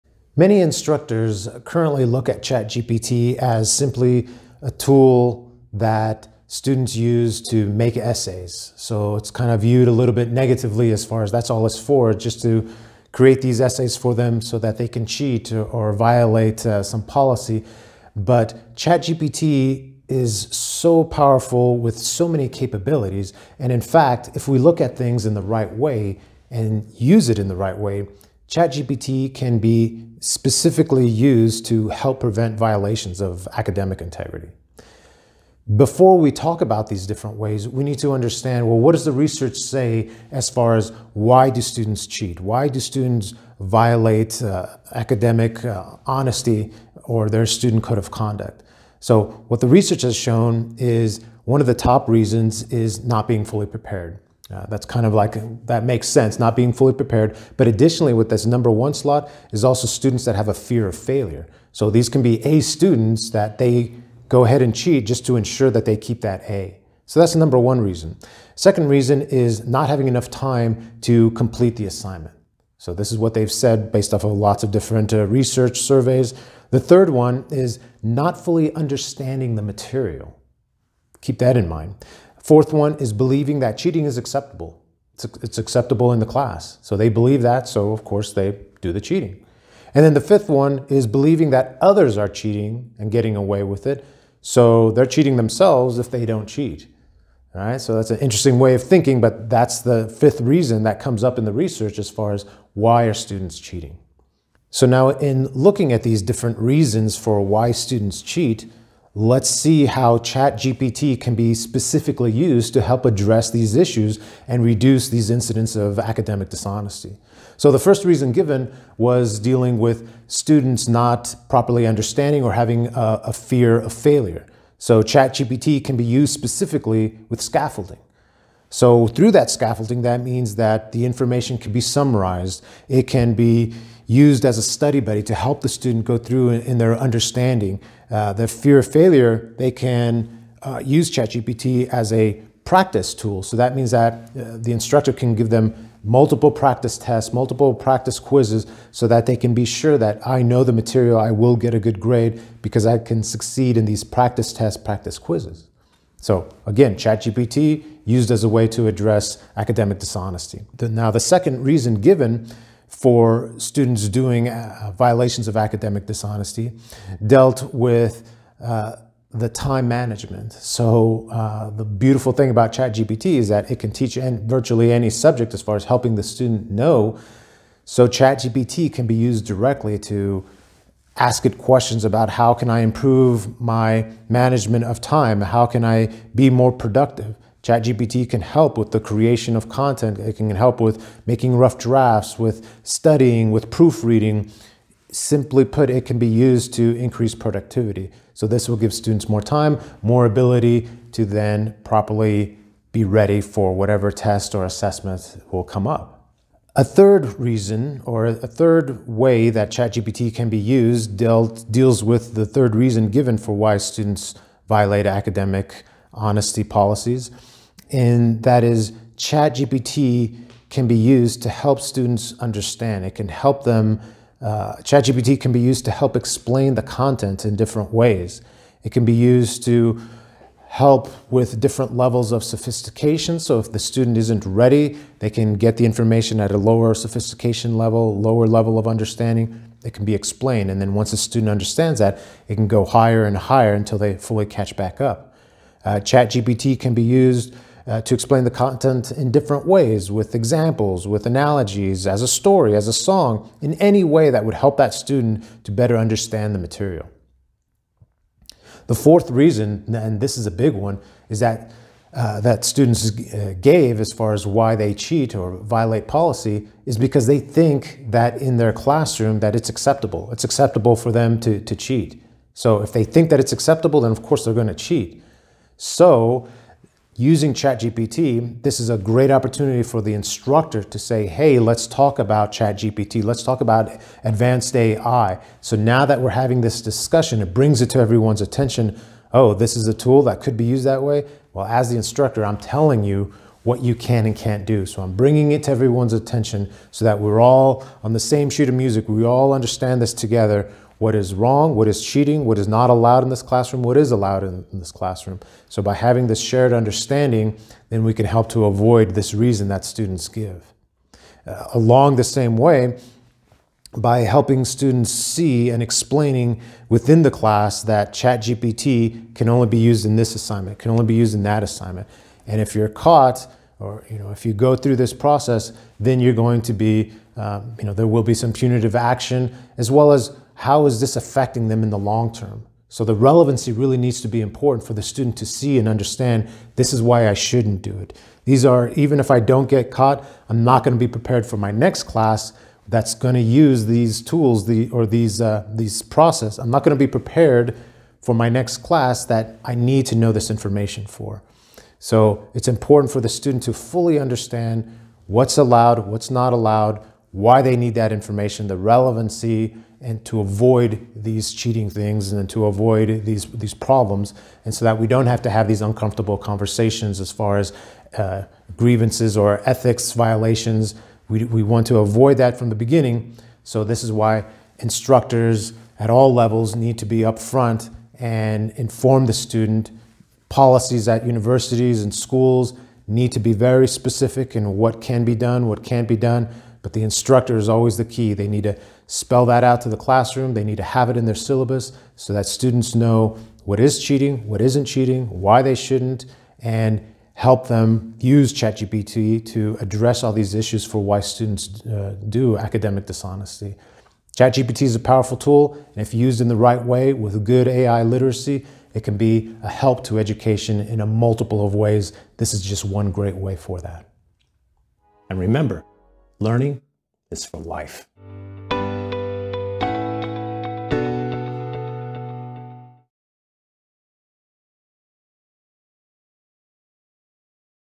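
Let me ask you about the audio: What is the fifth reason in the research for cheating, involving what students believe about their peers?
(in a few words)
others are cheating and getting away with it.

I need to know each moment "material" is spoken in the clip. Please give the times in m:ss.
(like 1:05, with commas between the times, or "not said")
1:19, 2:30, 4:16.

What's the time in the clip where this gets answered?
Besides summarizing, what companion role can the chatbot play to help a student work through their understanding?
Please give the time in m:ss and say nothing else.
2:14.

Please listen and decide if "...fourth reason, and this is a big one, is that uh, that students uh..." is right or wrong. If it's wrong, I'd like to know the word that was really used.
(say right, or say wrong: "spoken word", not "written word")
right.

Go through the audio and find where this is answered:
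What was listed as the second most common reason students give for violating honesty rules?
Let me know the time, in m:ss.
1:09.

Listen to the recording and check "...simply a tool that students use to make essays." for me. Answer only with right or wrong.
right.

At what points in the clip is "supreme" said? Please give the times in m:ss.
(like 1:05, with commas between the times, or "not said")
not said.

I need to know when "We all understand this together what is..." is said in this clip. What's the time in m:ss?
4:59.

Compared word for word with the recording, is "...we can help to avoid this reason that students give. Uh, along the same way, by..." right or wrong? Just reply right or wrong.
right.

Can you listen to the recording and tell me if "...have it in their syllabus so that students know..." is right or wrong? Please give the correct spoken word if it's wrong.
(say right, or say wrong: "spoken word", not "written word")
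right.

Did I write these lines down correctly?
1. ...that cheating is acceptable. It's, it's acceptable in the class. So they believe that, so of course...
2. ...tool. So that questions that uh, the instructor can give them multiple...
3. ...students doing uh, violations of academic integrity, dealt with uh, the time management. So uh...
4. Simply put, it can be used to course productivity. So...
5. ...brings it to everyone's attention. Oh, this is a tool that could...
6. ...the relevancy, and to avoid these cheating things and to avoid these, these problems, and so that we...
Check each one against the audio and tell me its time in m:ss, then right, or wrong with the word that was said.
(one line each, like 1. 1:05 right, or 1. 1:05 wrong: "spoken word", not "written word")
1. 1:23 right
2. 2:23 wrong: "means", not "questions"
3. 2:43 wrong: "dishonesty", not "integrity"
4. 3:15 wrong: "increase", not "course"
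5. 4:47 right
6. 5:58 right.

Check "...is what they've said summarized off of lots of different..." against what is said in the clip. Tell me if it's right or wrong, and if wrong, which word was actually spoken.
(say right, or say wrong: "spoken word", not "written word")
wrong: "based", not "summarized".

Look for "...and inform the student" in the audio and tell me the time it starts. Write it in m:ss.
6:18.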